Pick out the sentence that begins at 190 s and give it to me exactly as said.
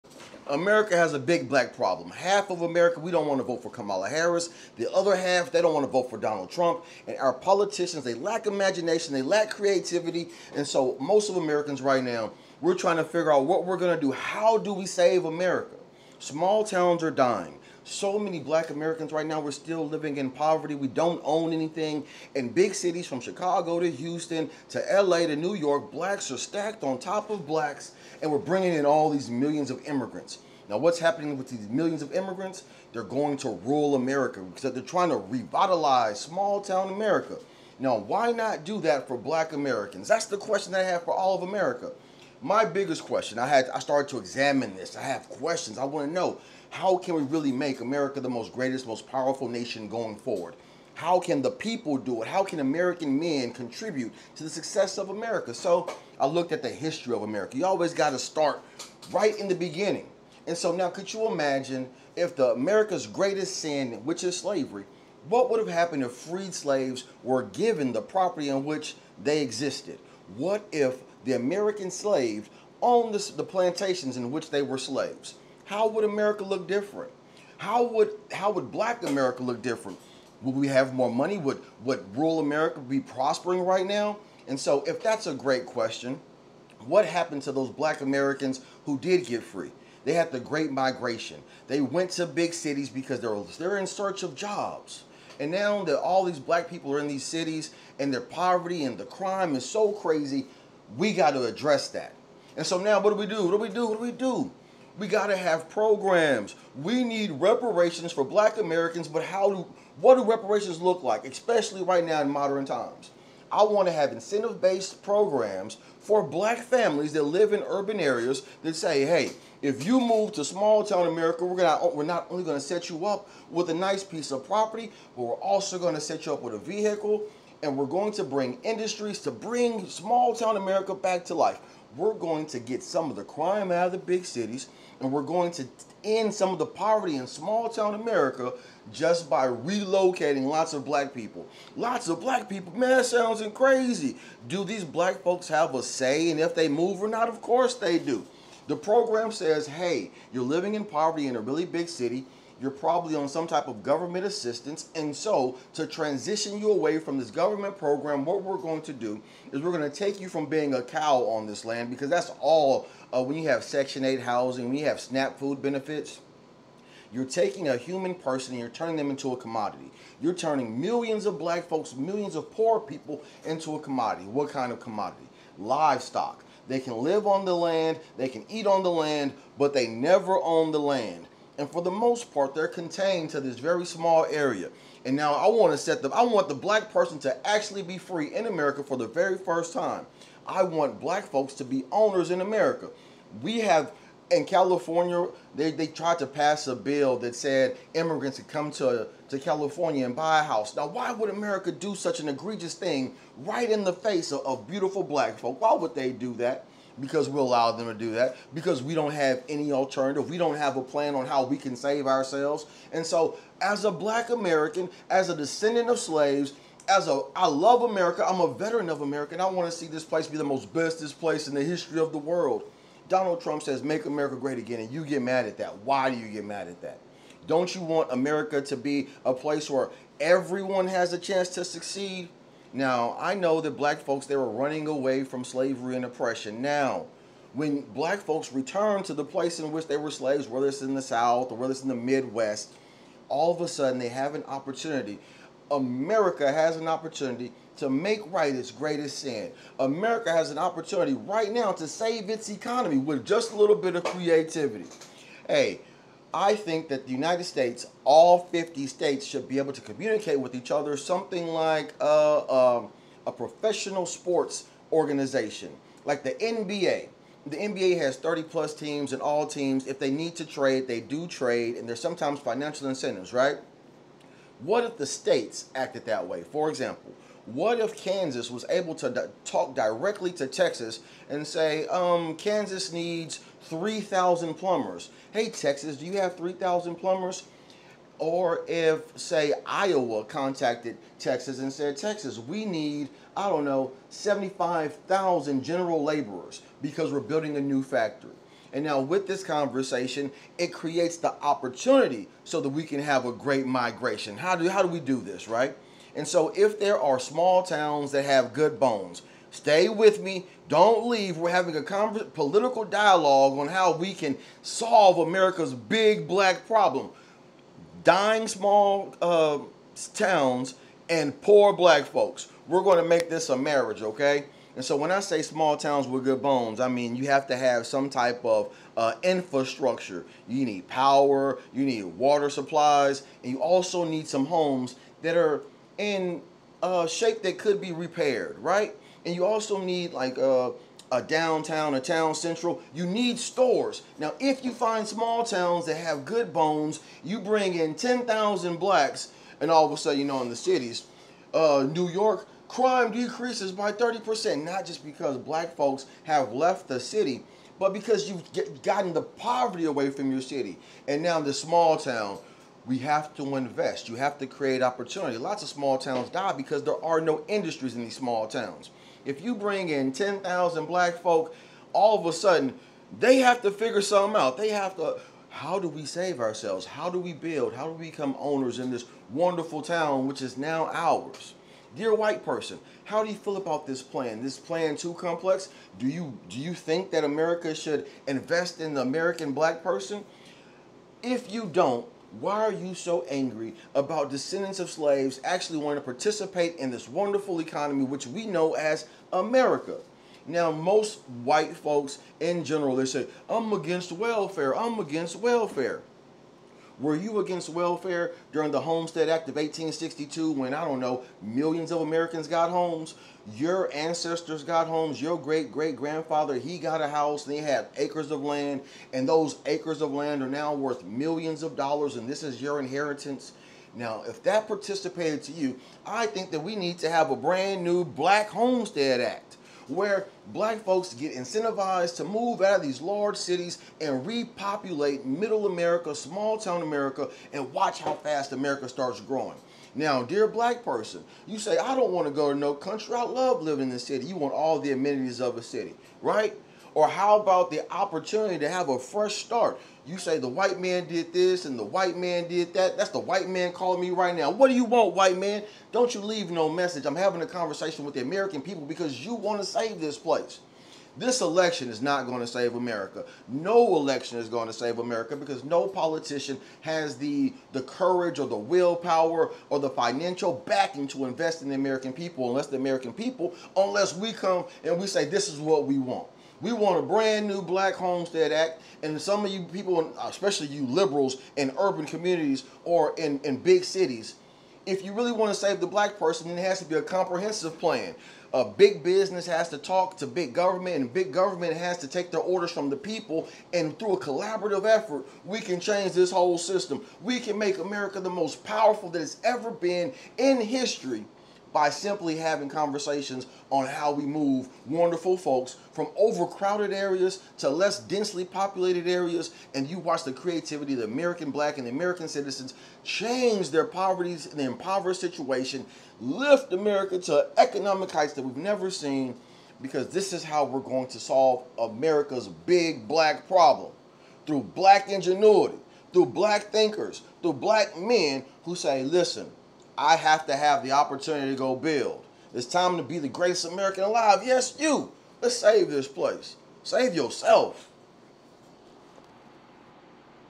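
I want black folks to be owners in America.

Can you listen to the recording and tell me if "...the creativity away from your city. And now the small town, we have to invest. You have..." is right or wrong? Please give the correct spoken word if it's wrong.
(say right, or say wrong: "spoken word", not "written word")
wrong: "poverty", not "creativity".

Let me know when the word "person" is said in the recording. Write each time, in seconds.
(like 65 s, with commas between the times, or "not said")
168 s, 186 s, 382 s, 389 s, 440 s, 486 s.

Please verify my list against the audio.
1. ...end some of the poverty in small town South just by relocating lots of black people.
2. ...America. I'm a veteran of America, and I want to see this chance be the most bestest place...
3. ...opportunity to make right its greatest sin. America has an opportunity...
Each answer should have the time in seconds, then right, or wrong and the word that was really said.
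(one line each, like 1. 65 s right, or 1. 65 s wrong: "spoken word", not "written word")
1. 136 s wrong: "America", not "South"
2. 217 s wrong: "place", not "chance"
3. 246 s right.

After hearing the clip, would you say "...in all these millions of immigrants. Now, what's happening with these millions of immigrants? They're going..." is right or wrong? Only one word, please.
right.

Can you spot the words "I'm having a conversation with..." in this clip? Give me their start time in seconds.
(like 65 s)
457 s.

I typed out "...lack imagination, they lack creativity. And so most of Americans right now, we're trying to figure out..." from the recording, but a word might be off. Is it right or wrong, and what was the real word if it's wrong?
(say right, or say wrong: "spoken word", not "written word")
right.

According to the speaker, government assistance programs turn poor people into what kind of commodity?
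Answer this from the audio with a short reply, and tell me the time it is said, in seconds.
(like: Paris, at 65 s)
Livestock, at 175 s.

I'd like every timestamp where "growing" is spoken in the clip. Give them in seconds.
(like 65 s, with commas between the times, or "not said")
439 s.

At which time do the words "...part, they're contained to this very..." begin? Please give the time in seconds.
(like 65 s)
182 s.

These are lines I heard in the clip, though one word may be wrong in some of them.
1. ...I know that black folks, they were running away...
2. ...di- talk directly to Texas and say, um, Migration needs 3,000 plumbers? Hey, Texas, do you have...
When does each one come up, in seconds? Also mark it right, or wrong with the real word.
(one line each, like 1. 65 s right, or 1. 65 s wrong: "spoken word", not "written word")
1. 233 s right
2. 279 s wrong: "Kansas", not "Migration".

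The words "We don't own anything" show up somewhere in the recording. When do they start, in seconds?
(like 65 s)
20 s.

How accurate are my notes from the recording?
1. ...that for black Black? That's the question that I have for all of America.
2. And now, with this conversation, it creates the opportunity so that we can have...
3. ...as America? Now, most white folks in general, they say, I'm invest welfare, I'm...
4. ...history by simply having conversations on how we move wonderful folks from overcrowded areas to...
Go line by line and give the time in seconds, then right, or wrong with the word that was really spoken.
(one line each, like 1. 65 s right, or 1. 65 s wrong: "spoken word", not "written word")
1. 38 s wrong: "Americans", not "Black"
2. 298 s right
3. 398 s wrong: "against", not "invest"
4. 500 s right.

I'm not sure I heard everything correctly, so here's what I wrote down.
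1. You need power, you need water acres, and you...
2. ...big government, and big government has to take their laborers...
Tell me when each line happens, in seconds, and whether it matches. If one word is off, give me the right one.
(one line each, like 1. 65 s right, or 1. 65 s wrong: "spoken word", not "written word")
1. 330 s wrong: "supplies", not "acres"
2. 490 s wrong: "orders", not "laborers".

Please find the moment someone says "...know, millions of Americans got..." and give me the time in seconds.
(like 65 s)
410 s.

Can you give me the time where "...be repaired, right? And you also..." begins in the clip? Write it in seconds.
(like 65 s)
337 s.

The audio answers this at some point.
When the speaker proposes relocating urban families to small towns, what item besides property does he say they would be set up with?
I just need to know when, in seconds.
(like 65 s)
126 s.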